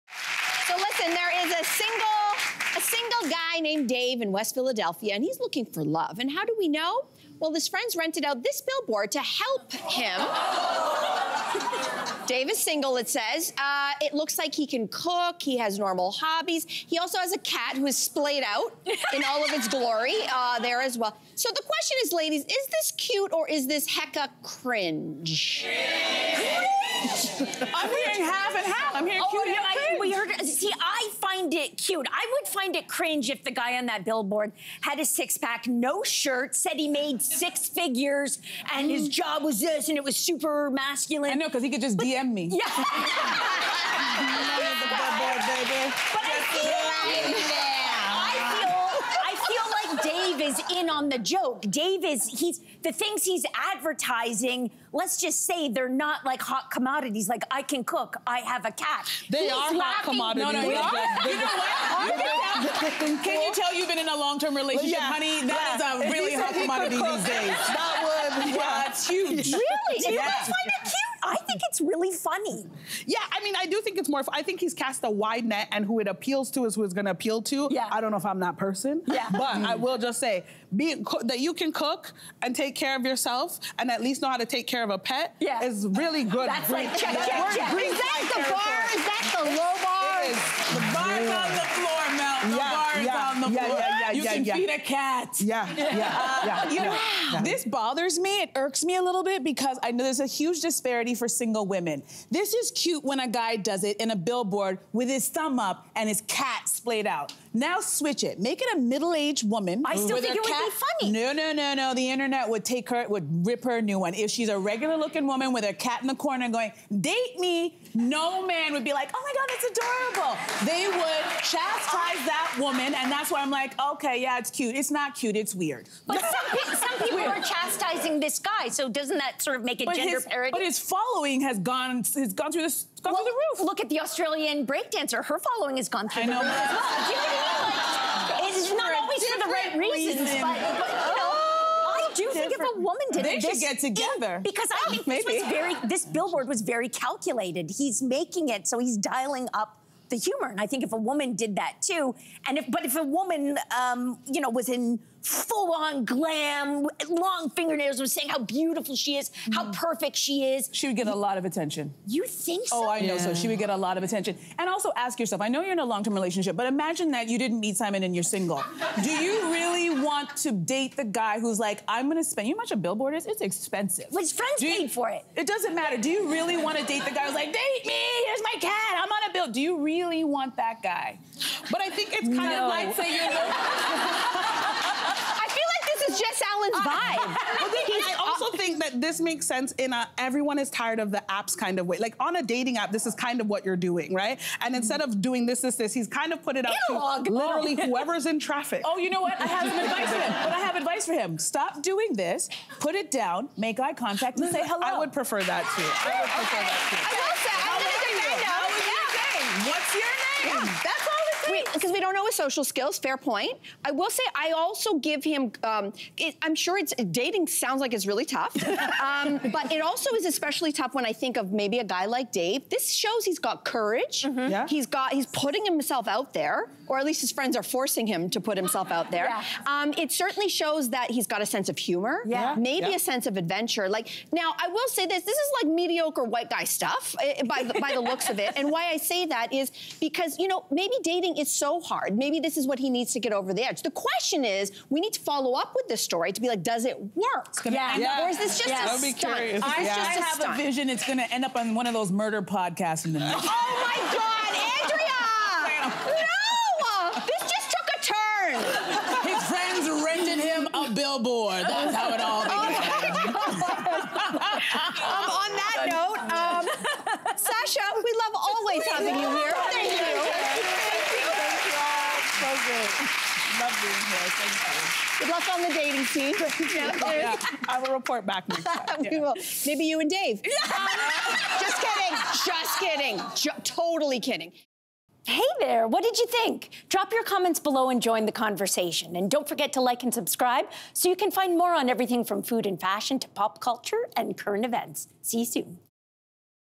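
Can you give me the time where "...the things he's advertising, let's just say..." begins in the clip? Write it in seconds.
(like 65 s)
52 s.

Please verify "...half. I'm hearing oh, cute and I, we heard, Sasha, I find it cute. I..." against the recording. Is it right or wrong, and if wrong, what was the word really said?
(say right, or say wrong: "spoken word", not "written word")
wrong: "See", not "Sasha".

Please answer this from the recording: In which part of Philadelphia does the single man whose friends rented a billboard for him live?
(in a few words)
West Philadelphia.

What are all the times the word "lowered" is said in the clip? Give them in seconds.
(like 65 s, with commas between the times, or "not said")
not said.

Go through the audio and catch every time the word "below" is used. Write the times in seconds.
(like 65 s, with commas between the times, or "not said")
287 s.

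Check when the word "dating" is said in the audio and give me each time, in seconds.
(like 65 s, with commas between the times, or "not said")
192 s, 217 s, 241 s, 275 s.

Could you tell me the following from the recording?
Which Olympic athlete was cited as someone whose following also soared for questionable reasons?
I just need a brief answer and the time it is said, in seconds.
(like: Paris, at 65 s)
The Australian breakdancer, at 133 s.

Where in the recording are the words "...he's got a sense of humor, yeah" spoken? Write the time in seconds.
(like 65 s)
231 s.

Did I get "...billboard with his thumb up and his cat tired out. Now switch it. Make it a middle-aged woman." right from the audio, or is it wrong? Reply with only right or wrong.
wrong.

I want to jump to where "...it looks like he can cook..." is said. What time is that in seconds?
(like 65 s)
13 s.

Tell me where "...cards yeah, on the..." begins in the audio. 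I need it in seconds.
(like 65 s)
92 s.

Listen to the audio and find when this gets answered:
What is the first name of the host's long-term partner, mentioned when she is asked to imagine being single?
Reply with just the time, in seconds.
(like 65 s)
167 s.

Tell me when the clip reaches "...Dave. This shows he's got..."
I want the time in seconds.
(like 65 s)
222 s.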